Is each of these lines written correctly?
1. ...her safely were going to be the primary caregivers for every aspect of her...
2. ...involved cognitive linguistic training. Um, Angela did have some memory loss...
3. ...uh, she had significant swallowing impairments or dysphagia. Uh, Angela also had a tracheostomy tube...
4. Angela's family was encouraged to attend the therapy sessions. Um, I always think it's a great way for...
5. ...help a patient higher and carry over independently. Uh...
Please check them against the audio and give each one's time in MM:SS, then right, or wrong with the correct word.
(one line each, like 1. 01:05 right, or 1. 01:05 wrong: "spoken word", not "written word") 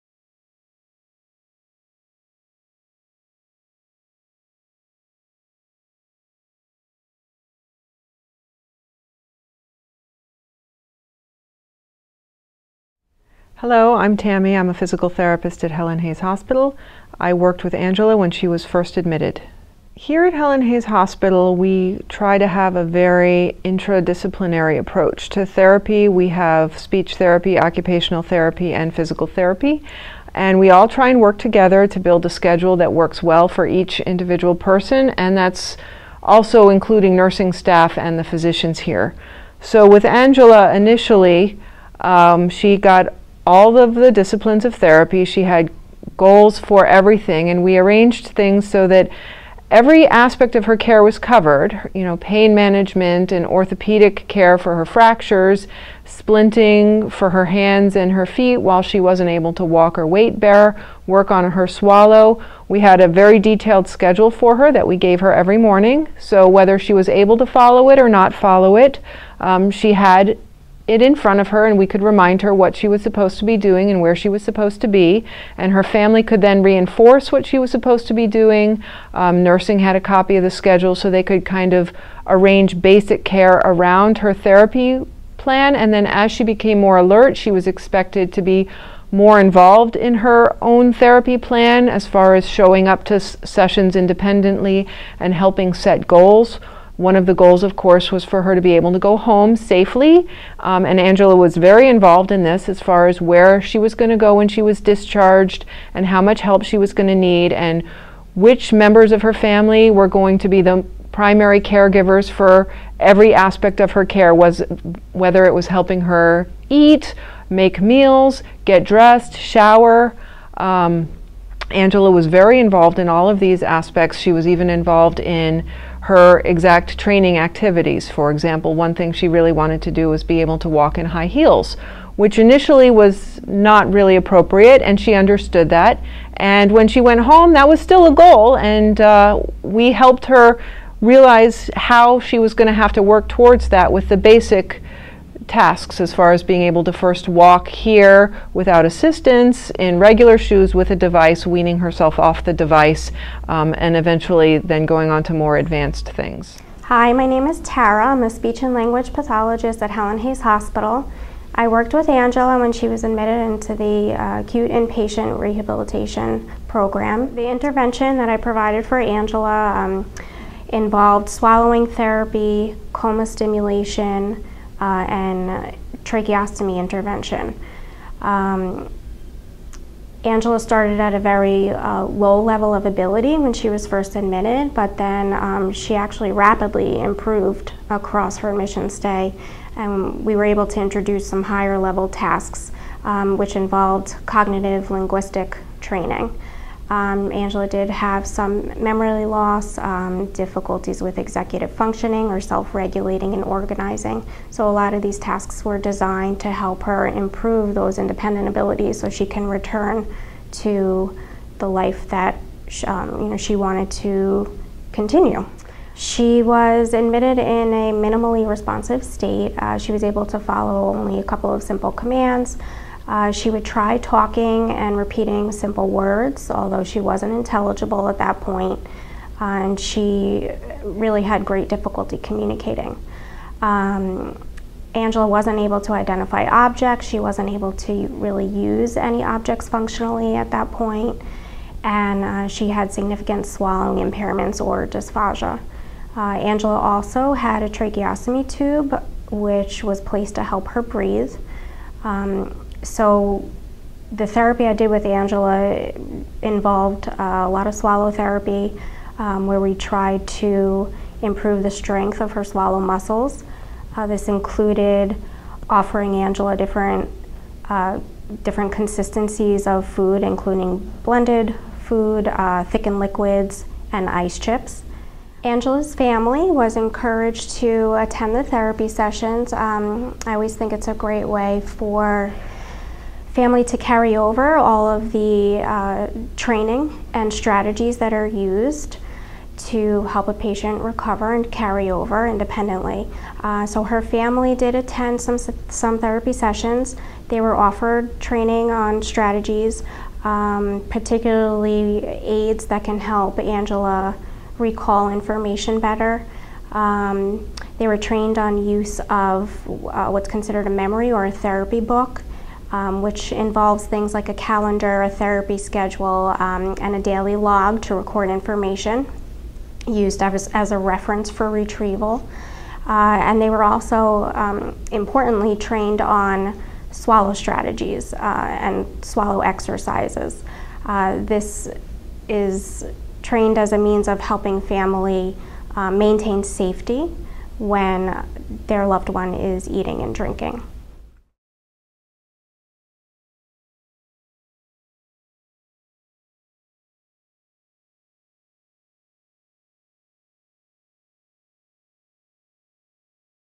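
1. 01:49 wrong: "family", not "safely"
2. 03:13 right
3. 04:02 right
4. 04:35 right
5. 04:50 wrong: "recover", not "higher".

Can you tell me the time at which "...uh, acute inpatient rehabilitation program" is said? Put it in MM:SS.
02:44.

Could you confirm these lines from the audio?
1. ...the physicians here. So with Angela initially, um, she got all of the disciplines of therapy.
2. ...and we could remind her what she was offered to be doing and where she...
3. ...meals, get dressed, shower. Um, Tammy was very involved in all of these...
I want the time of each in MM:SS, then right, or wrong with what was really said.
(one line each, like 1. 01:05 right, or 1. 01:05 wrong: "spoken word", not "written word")
1. 00:38 right
2. 01:11 wrong: "supposed", not "offered"
3. 01:57 wrong: "Angela", not "Tammy".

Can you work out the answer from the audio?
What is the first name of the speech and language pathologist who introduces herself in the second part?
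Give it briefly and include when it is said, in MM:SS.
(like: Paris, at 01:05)
Tara, at 02:37.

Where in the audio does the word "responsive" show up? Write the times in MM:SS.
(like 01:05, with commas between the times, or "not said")
03:38.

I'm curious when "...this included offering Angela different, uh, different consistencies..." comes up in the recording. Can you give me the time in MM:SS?
04:24.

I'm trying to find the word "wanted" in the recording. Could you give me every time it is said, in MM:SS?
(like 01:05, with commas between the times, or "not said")
02:09, 03:33.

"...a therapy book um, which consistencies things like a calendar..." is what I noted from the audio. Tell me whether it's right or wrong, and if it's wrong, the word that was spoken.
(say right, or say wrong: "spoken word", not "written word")
wrong: "involves", not "consistencies".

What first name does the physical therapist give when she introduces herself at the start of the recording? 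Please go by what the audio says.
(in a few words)
Tammy.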